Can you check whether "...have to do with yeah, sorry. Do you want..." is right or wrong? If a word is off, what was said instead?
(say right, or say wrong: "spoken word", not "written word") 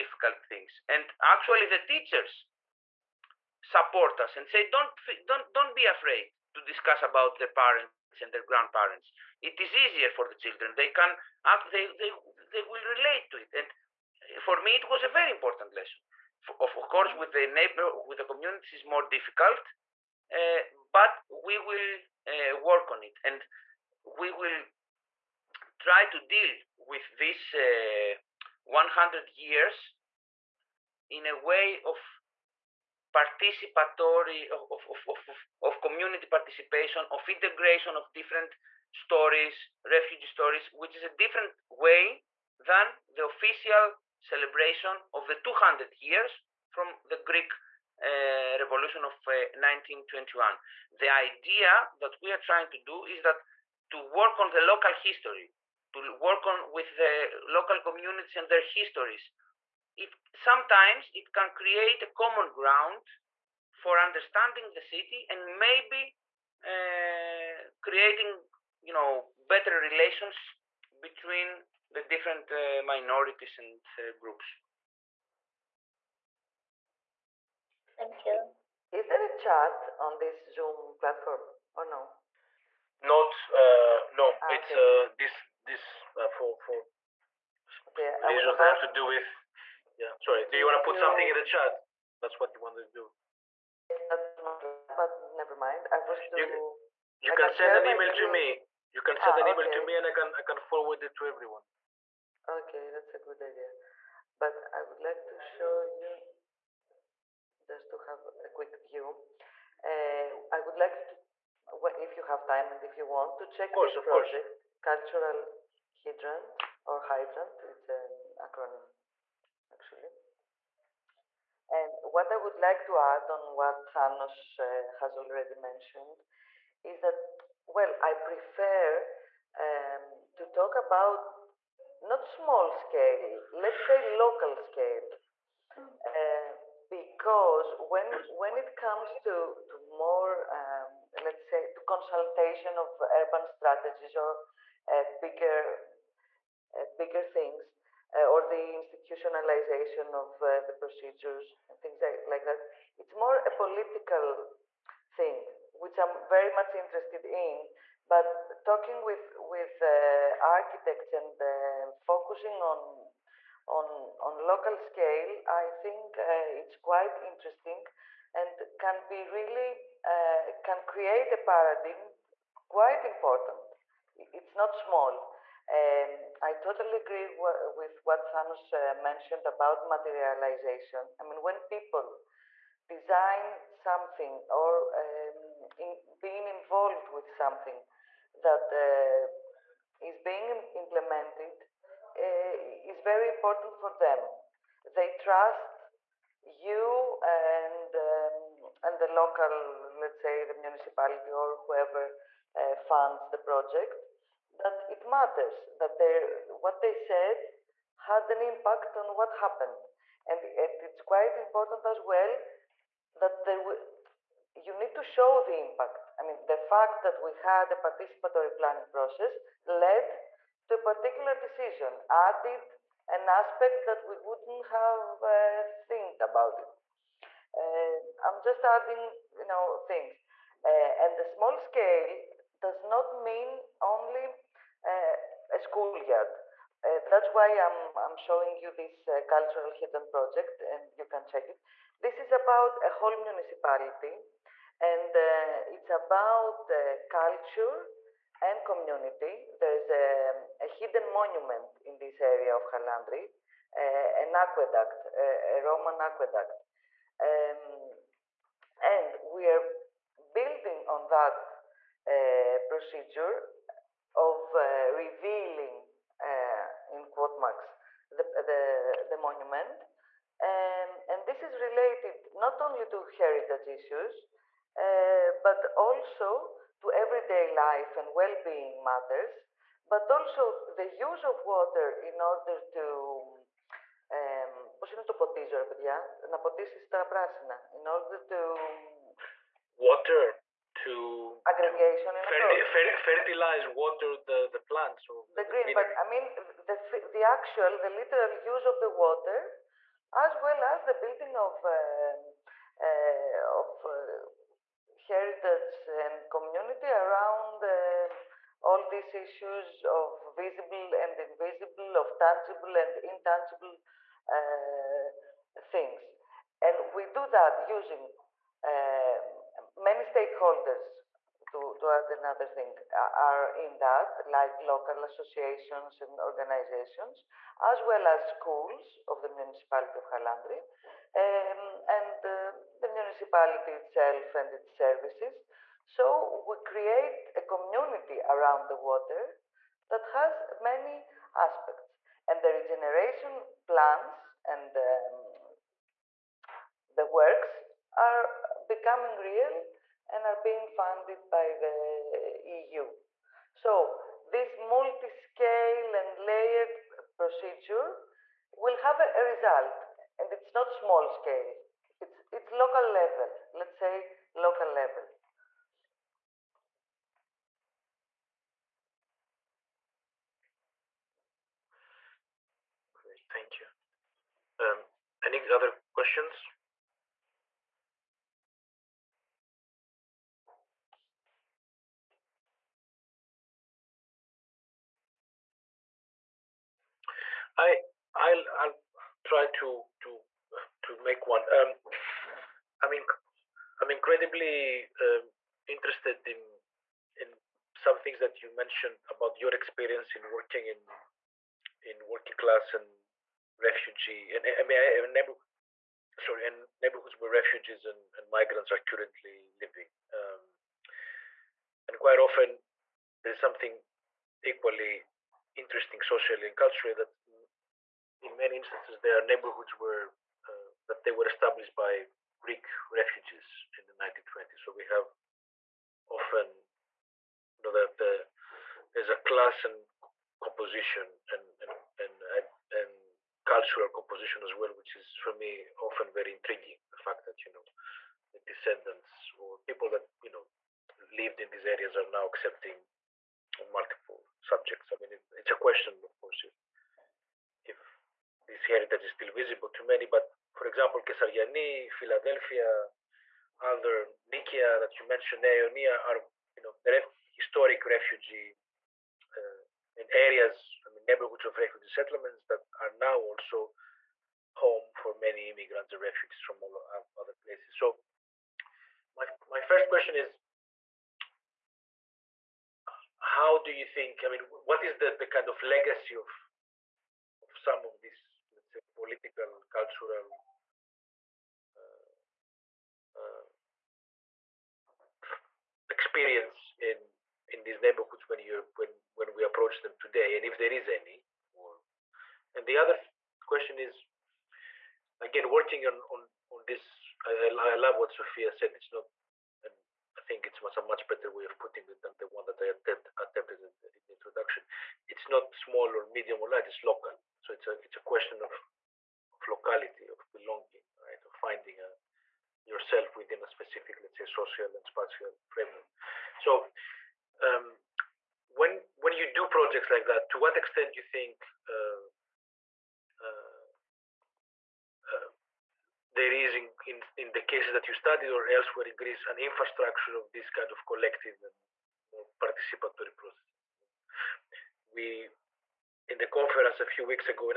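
right.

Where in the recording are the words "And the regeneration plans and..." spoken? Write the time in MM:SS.
05:42.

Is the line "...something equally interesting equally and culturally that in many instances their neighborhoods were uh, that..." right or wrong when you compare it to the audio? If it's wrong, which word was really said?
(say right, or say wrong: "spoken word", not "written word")
wrong: "socially", not "equally".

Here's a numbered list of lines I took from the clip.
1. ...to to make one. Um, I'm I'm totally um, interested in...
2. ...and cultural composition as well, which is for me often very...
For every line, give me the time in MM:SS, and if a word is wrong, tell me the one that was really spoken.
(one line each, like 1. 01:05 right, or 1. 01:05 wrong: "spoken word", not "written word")
1. 06:30 wrong: "incredibly", not "totally"
2. 07:12 right.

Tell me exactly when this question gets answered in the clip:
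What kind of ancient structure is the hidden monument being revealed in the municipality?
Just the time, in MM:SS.
04:15.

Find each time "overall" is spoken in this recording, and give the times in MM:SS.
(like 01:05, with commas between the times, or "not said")
not said.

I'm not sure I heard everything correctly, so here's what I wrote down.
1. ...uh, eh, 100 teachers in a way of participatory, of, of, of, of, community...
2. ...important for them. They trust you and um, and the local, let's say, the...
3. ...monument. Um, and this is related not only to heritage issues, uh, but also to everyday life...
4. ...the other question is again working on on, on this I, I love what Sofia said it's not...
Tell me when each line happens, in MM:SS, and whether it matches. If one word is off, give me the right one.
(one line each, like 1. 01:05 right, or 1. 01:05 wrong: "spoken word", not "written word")
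1. 00:27 wrong: "years", not "teachers"
2. 03:13 right
3. 04:29 right
4. 08:12 right.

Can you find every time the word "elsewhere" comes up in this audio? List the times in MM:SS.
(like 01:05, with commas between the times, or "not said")
08:48.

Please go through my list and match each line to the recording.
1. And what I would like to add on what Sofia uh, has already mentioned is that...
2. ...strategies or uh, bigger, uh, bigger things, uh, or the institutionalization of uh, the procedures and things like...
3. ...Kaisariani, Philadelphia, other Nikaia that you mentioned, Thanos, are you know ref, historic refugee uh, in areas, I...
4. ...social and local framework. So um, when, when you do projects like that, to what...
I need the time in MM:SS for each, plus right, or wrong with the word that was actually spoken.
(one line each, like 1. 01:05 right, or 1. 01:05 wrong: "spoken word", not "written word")
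1. 02:01 wrong: "Thanos", not "Sofia"
2. 02:23 right
3. 07:31 wrong: "Aeonia", not "Thanos"
4. 08:34 wrong: "spatial", not "local".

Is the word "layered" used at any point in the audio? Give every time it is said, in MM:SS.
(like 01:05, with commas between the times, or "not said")
05:56.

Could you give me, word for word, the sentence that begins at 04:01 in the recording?
This is about a whole municipality and uh, it's about culture and community.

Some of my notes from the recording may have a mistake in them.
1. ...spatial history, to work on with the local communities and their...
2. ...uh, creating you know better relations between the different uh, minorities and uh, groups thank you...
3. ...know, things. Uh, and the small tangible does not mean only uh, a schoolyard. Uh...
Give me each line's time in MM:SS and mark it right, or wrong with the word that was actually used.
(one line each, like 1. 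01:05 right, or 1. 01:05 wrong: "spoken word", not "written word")
1. 00:54 wrong: "local", not "spatial"
2. 01:06 right
3. 03:49 wrong: "scale", not "tangible".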